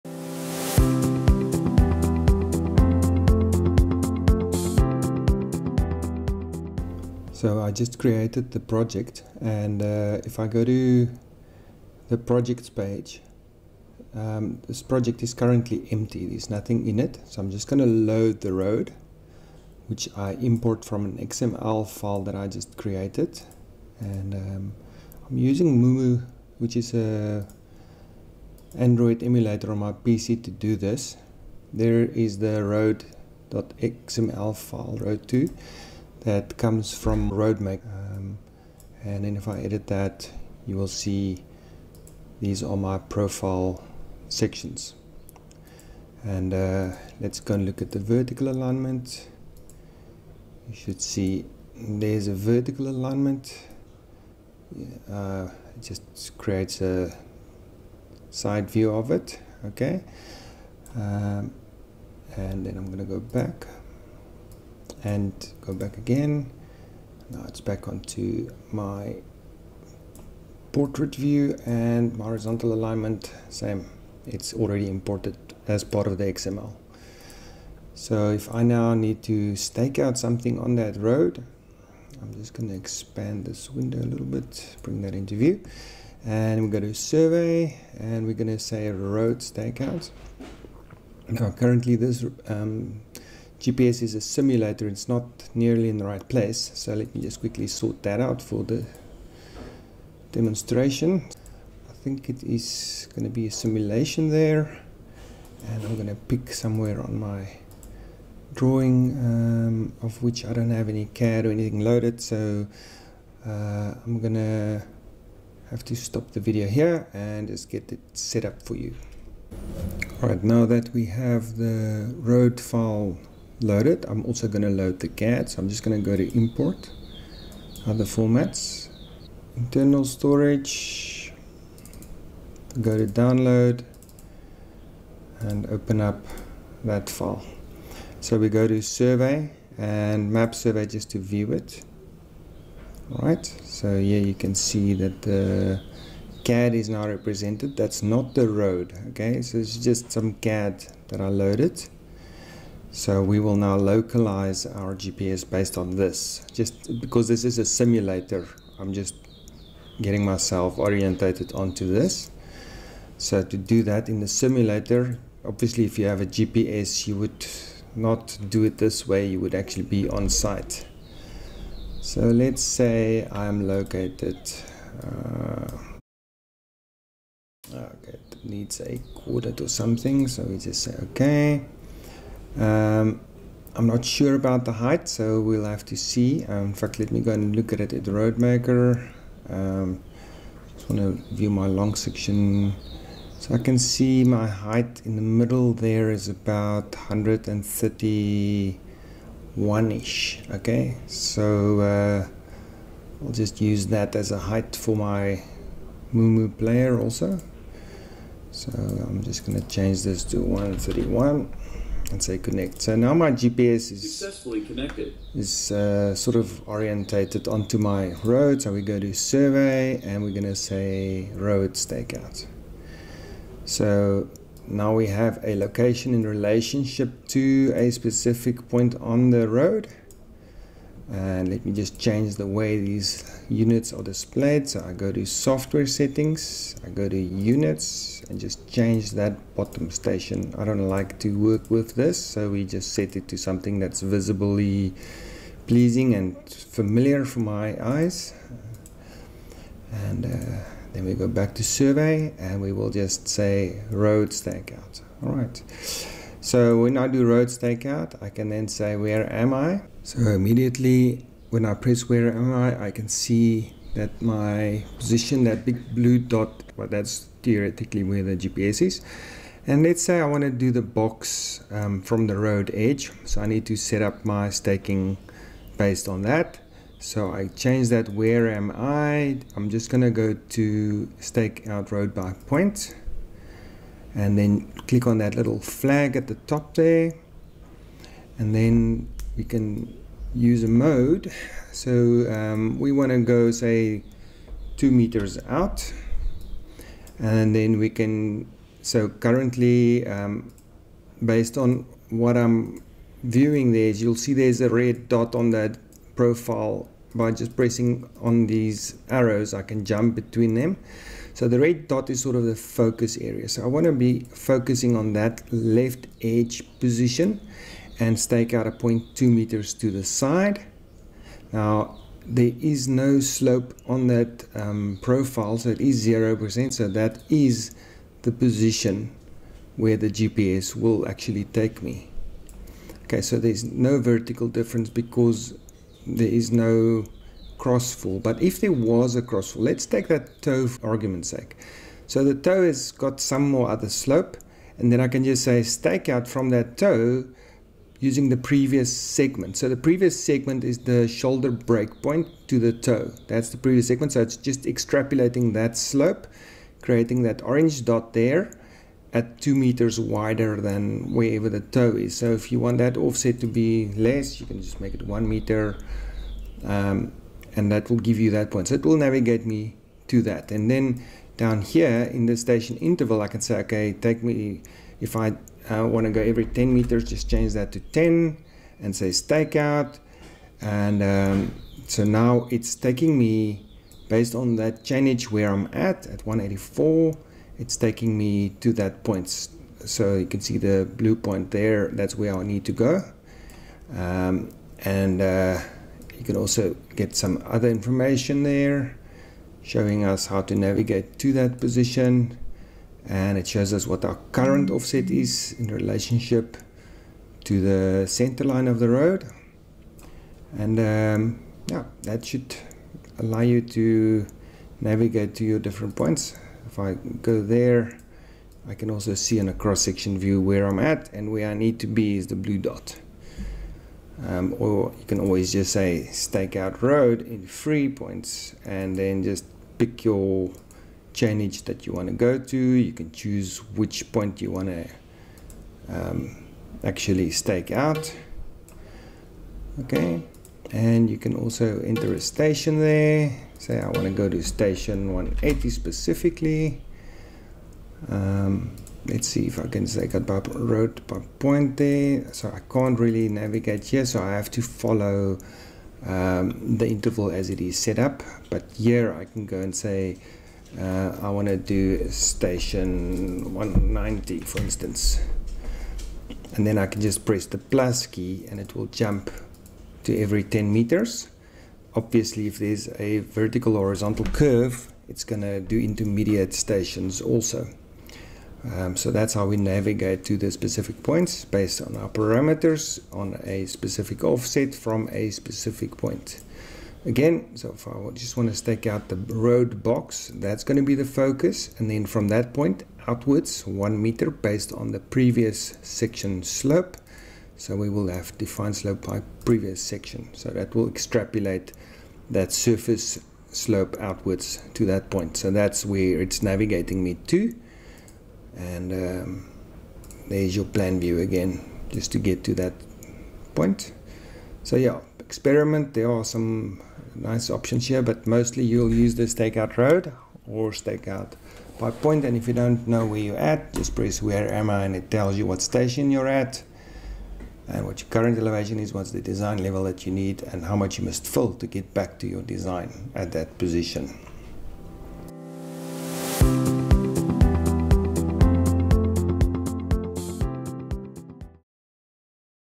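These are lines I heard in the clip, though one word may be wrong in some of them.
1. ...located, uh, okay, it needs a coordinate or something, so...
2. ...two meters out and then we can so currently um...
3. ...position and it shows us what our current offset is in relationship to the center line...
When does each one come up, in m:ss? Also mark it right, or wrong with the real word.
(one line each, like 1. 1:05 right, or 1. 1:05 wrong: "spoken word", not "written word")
1. 2:53 right
2. 4:54 right
3. 6:41 right.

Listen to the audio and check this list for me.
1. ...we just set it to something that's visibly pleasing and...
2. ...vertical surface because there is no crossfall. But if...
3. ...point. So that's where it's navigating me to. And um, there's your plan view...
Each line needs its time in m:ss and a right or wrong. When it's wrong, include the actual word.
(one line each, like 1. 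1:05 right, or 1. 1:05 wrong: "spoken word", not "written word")
1. 4:02 right
2. 5:33 wrong: "difference", not "surface"
3. 8:25 right.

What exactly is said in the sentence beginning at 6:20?
And um, so now it's taking me based on that change where I'm at, at 184, it's taking me to that point.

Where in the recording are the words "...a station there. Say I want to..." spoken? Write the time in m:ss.
7:22.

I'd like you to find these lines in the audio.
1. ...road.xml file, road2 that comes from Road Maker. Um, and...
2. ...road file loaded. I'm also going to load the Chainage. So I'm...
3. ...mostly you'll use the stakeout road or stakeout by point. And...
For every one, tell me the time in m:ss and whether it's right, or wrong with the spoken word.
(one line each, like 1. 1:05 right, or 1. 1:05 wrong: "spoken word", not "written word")
1. 0:32 right
2. 2:02 wrong: "CAD", not "Chainage"
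3. 8:38 right.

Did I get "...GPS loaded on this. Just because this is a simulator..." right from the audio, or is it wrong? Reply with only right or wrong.
wrong.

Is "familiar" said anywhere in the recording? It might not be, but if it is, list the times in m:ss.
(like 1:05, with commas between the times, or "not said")
4:06.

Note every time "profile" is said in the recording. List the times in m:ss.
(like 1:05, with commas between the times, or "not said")
0:42, 5:06, 5:25.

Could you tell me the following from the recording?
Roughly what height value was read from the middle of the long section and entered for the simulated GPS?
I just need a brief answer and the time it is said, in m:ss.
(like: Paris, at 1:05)
131, at 3:30.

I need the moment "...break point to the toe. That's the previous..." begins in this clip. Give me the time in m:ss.
5:51.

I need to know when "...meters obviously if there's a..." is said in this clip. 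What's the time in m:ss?
7:50.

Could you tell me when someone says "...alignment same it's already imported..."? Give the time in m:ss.
1:12.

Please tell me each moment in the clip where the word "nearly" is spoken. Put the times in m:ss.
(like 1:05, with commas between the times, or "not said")
1:35.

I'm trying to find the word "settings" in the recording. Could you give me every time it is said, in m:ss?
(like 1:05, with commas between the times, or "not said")
3:55.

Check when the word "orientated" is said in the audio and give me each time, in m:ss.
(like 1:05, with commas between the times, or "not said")
2:40, 3:36.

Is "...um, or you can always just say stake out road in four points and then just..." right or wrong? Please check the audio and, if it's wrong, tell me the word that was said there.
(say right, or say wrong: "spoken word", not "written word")
wrong: "three", not "four".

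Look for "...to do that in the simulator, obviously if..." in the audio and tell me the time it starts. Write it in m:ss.
2:43.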